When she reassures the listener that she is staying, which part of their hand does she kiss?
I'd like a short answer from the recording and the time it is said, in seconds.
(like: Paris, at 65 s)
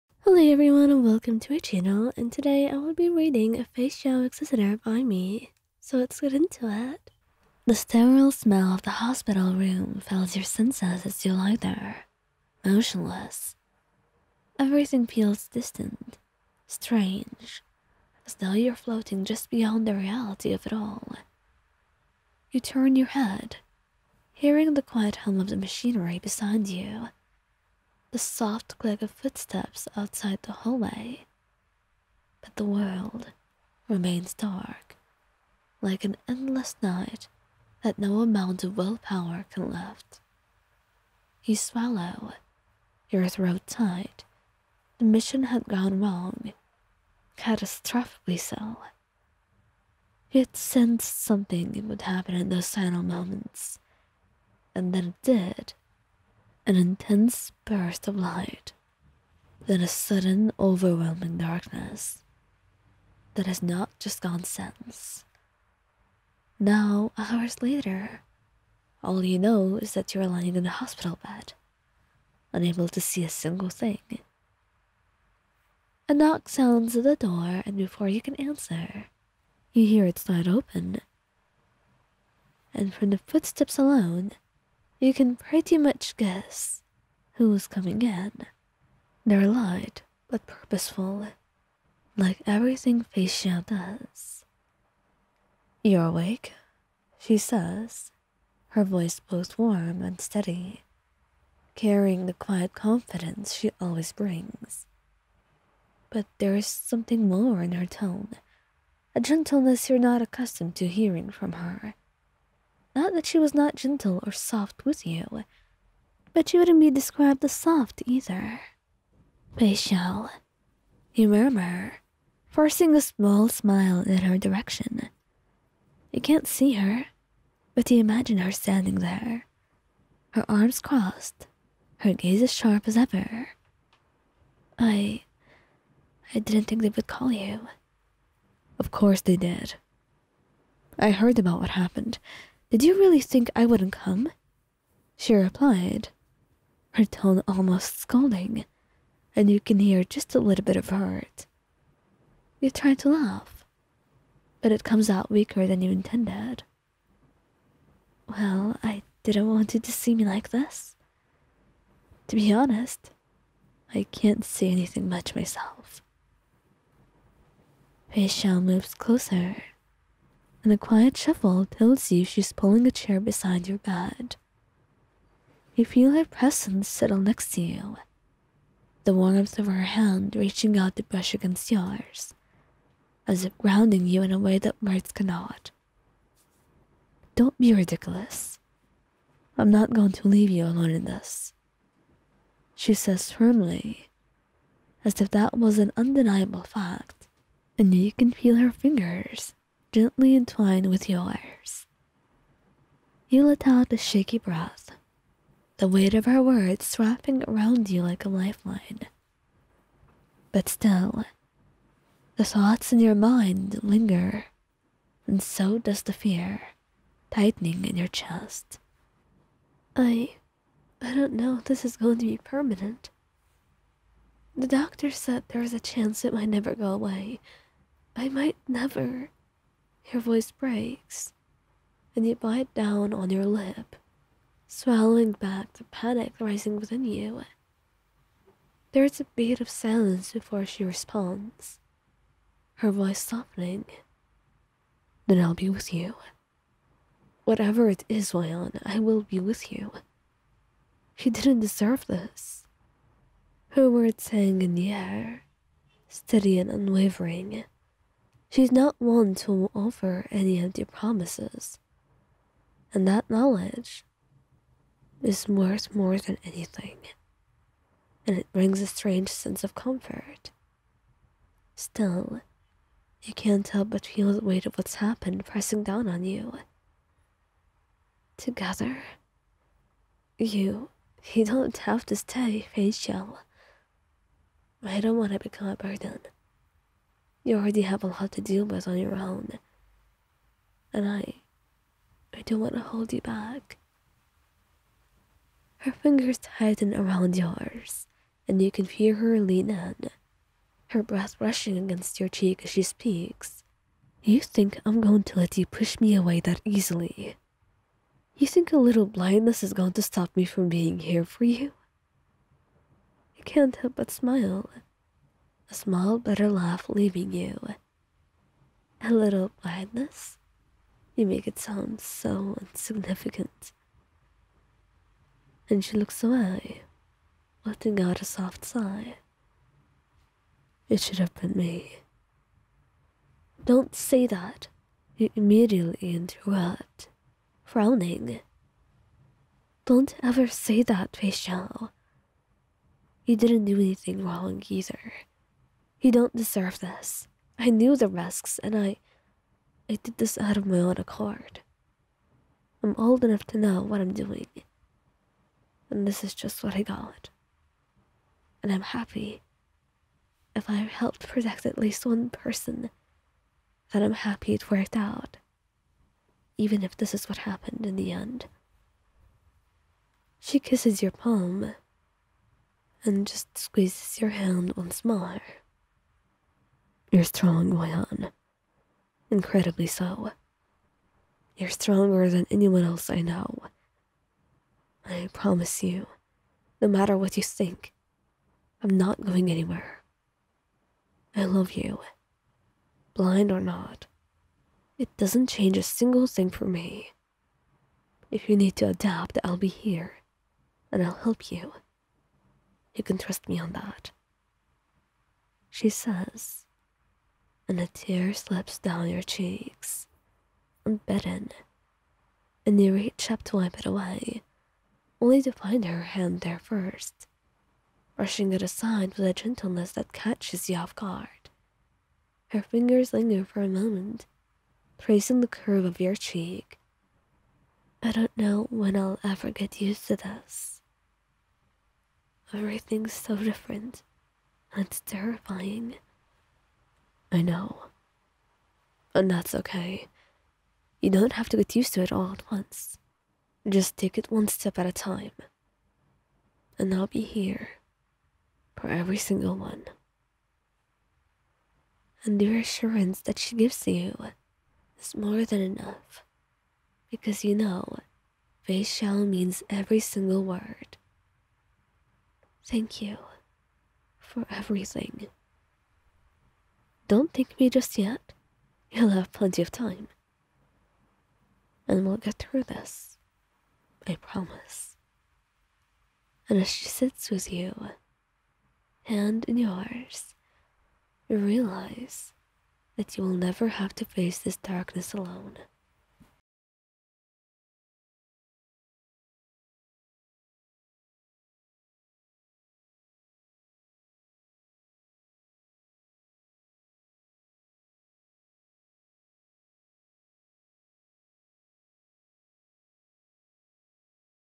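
Palm, at 371 s.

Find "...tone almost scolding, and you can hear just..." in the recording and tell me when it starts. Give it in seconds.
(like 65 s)
147 s.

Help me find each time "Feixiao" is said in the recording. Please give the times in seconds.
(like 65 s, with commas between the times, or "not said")
3 s, 93 s.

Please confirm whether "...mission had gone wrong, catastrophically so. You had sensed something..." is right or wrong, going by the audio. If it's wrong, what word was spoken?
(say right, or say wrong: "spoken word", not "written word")
right.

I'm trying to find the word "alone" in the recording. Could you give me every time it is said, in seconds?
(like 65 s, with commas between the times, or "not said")
83 s, 190 s, 485 s.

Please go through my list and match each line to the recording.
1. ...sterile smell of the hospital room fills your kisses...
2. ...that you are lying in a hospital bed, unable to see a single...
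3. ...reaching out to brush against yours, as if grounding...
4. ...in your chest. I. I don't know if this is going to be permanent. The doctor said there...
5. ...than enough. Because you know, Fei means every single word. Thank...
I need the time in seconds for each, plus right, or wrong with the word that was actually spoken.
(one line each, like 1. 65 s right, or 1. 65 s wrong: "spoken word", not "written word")
1. 7 s wrong: "senses", not "kisses"
2. 69 s right
3. 180 s right
4. 217 s right
5. 455 s right.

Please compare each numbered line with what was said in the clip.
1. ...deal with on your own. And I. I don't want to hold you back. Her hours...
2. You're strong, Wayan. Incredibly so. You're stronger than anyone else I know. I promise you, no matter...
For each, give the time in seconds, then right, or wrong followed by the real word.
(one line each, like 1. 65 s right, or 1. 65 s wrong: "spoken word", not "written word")
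1. 288 s wrong: "fingers", not "hours"
2. 377 s right.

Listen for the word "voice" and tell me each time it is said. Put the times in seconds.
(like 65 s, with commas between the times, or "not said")
98 s, 230 s, 242 s.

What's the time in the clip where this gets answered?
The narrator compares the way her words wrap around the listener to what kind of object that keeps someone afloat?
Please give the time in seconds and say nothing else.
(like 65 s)
208 s.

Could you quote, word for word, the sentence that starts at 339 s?
Don't ever say that, Fei You didn't do anything wrong either.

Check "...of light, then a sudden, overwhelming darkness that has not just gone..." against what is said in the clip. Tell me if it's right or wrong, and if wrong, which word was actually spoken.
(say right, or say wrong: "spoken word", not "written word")
right.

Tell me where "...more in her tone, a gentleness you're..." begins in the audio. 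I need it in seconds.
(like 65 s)
107 s.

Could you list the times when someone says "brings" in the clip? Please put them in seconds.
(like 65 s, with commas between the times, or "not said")
104 s, 268 s.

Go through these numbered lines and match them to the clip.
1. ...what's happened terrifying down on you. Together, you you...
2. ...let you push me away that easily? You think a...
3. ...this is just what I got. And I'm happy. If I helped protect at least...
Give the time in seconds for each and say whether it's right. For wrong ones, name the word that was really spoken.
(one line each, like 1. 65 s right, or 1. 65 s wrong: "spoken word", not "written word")
1. 274 s wrong: "pressing", not "terrifying"
2. 305 s right
3. 356 s right.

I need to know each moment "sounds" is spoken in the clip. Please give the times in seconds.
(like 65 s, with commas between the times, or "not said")
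76 s, 321 s.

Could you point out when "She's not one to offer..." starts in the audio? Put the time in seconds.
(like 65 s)
258 s.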